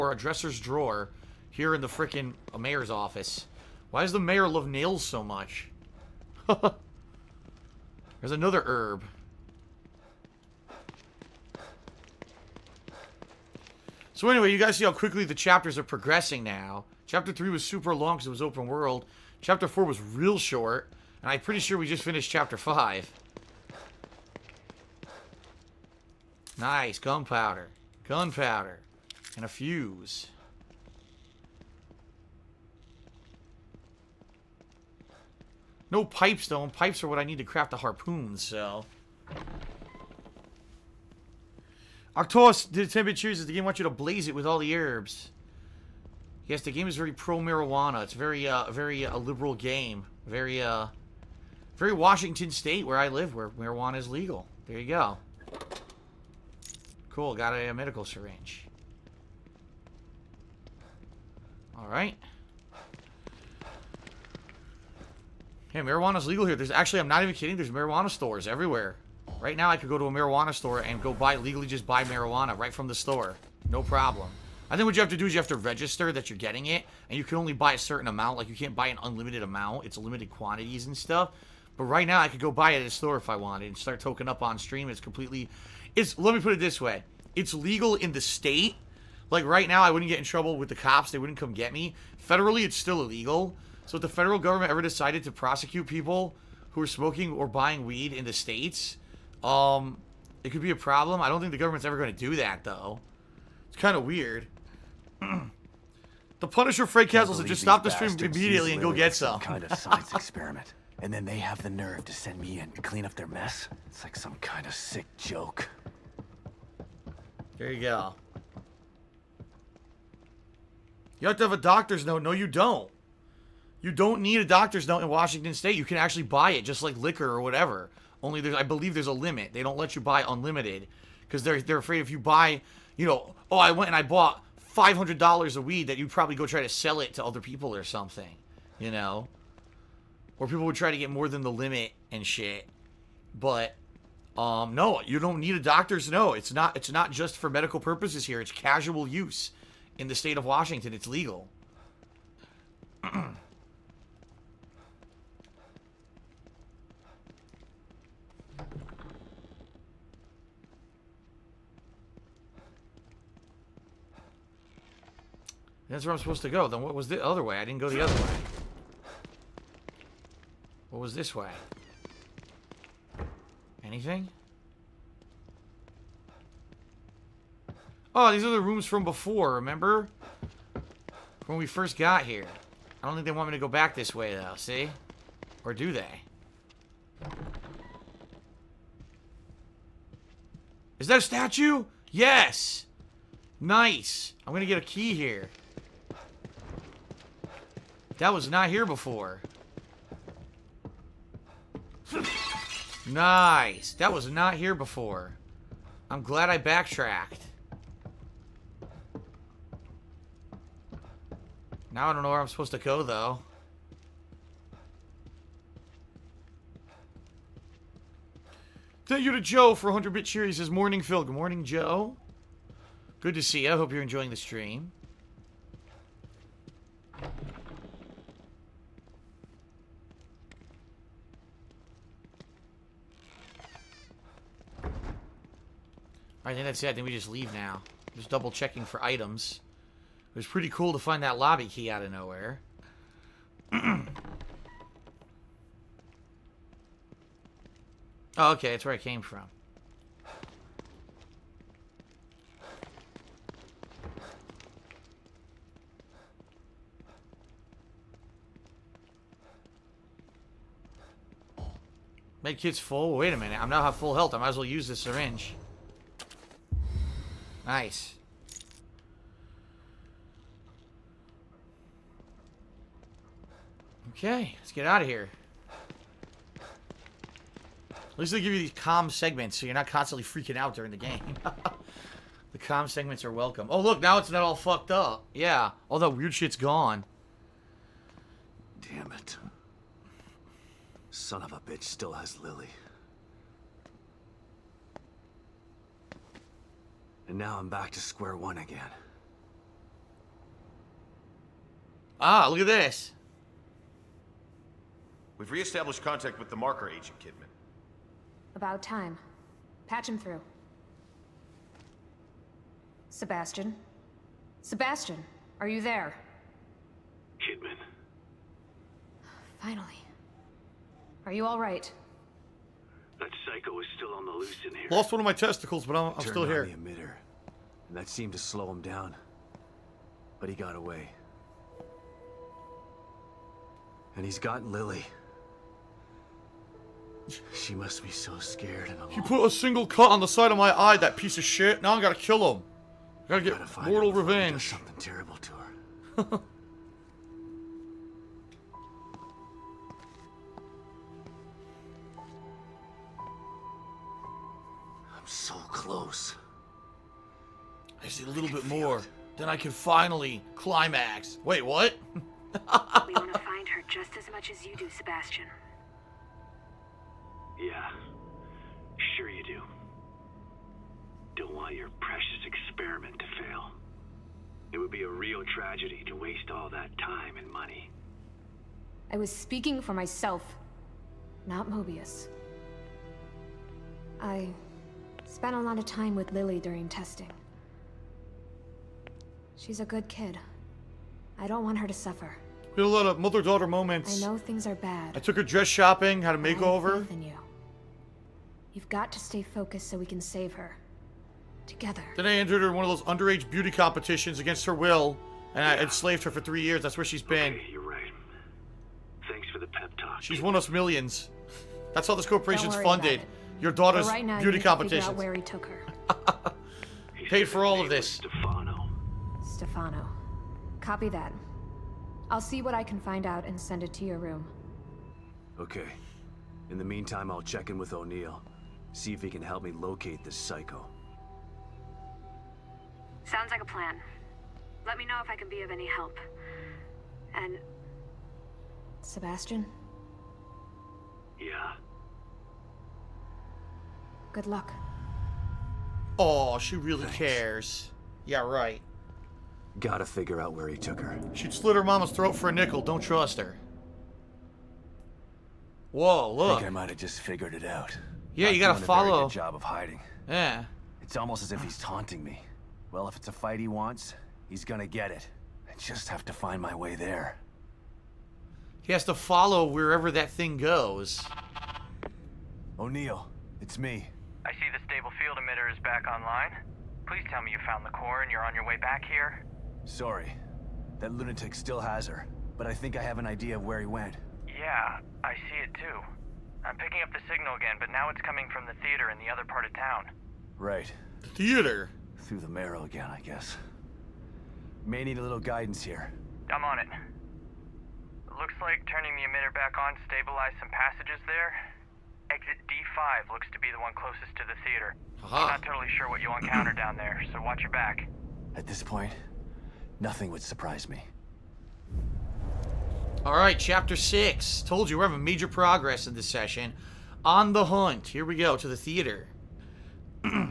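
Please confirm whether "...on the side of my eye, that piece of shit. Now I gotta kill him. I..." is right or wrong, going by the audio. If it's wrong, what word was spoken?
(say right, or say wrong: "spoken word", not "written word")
right.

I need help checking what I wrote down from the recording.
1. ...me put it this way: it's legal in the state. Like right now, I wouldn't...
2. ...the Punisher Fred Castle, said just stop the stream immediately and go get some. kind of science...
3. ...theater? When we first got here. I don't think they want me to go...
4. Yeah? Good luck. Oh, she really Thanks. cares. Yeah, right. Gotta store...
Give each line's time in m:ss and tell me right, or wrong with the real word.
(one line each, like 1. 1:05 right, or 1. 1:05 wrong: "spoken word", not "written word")
1. 1:26 right
2. 1:46 right
3. 2:59 wrong: "remember", not "theater"
4. 7:21 wrong: "figure", not "store".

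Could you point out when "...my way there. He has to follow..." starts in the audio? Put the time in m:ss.
7:46.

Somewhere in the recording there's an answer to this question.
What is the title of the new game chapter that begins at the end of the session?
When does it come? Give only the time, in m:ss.
8:37.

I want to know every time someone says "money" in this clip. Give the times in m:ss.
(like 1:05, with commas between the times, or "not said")
6:17.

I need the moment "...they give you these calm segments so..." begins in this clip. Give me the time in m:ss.
4:38.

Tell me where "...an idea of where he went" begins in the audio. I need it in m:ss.
8:03.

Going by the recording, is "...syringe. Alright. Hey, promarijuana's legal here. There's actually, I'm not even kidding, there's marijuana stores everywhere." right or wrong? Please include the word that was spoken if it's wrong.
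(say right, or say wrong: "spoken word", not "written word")
wrong: "marijuana", not "promarijuana".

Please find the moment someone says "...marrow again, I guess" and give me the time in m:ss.
8:12.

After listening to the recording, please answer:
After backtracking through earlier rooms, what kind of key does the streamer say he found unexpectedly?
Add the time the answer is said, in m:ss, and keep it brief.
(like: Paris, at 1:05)
Lobby key, at 4:01.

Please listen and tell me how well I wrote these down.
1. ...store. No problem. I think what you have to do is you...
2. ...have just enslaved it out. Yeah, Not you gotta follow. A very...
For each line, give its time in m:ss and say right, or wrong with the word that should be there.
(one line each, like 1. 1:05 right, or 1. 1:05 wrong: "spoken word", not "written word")
1. 1:12 right
2. 7:36 wrong: "figured", not "enslaved".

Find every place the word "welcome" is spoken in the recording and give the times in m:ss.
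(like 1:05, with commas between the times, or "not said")
4:43.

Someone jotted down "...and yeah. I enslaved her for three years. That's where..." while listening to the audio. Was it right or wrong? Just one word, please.
right.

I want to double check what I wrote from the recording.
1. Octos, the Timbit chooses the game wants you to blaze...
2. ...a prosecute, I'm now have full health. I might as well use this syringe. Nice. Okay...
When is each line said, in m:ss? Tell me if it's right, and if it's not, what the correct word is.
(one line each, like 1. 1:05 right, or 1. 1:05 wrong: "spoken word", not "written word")
1. 0:42 right
2. 4:23 wrong: "minute", not "prosecute".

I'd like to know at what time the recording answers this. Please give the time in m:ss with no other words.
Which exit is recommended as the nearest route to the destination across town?
8:22.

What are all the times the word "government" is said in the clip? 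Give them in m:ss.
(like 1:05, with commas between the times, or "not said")
1:34, 1:41.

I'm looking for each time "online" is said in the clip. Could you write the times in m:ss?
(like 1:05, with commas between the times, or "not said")
7:56.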